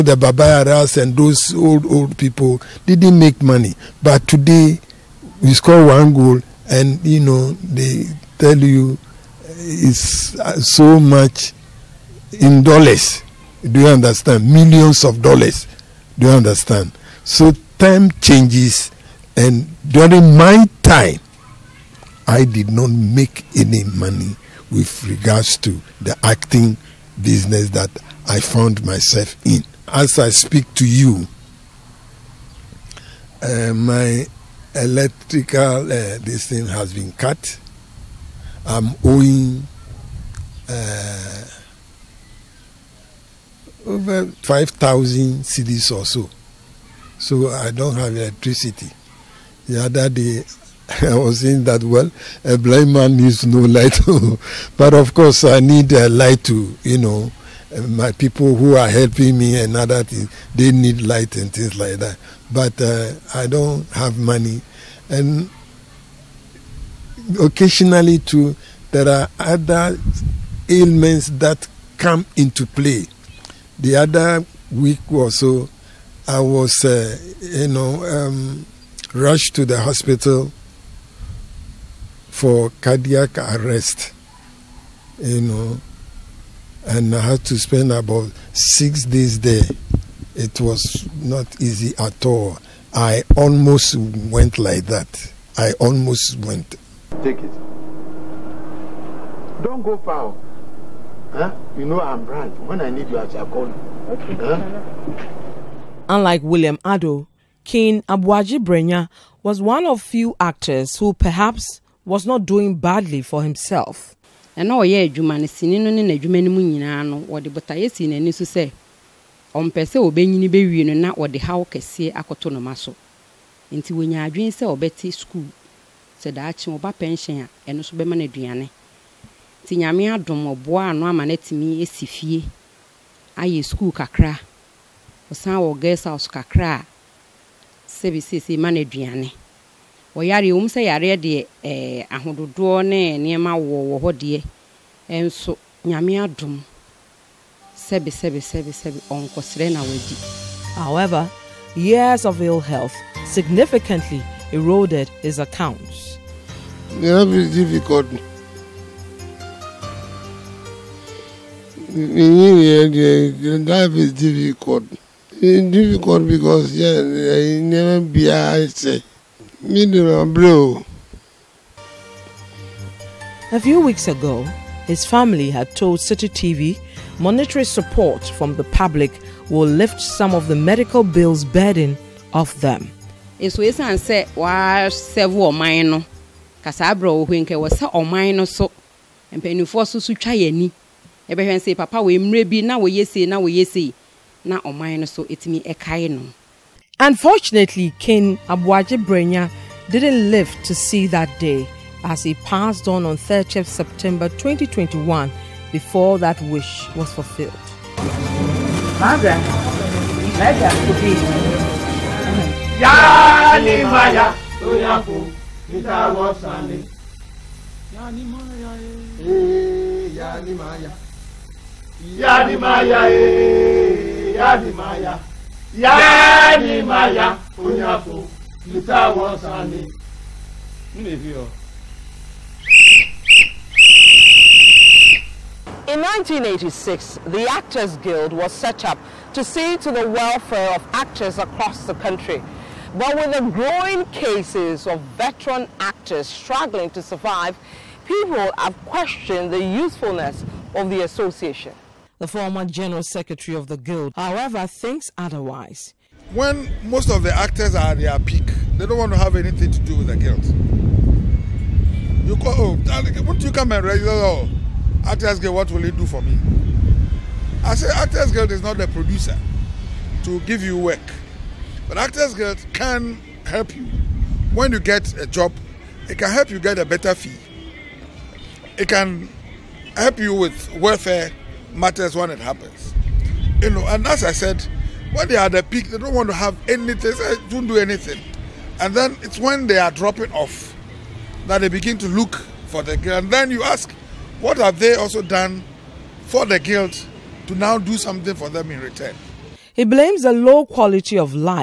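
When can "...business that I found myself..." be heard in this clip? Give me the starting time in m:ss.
0:27.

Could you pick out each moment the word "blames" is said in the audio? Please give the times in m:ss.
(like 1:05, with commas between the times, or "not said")
4:59.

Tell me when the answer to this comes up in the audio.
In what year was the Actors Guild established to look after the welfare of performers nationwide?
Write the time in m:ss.
3:56.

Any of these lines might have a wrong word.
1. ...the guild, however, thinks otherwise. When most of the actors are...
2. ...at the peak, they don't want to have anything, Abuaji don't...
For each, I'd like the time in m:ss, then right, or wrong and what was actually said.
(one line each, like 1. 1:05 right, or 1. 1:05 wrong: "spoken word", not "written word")
1. 4:13 right
2. 4:45 wrong: "They", not "Abuaji".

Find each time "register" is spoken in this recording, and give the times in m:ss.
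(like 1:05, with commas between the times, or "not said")
4:23.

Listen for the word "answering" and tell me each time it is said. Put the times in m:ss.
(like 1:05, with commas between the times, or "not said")
not said.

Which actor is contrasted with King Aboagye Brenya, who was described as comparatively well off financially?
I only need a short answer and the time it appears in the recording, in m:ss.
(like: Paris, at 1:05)
William Addo, at 1:46.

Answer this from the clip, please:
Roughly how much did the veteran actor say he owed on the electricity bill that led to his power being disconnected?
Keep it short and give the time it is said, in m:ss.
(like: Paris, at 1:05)
5,000 cedis, at 0:44.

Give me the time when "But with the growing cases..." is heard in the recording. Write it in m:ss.
4:02.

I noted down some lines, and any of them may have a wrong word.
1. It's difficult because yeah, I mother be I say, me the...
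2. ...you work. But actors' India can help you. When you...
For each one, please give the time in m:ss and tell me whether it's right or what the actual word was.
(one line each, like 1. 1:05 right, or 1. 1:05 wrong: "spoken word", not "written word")
1. 2:45 wrong: "never", not "mother"
2. 4:30 wrong: "Guild", not "India".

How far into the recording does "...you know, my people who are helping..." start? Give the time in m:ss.
0:56.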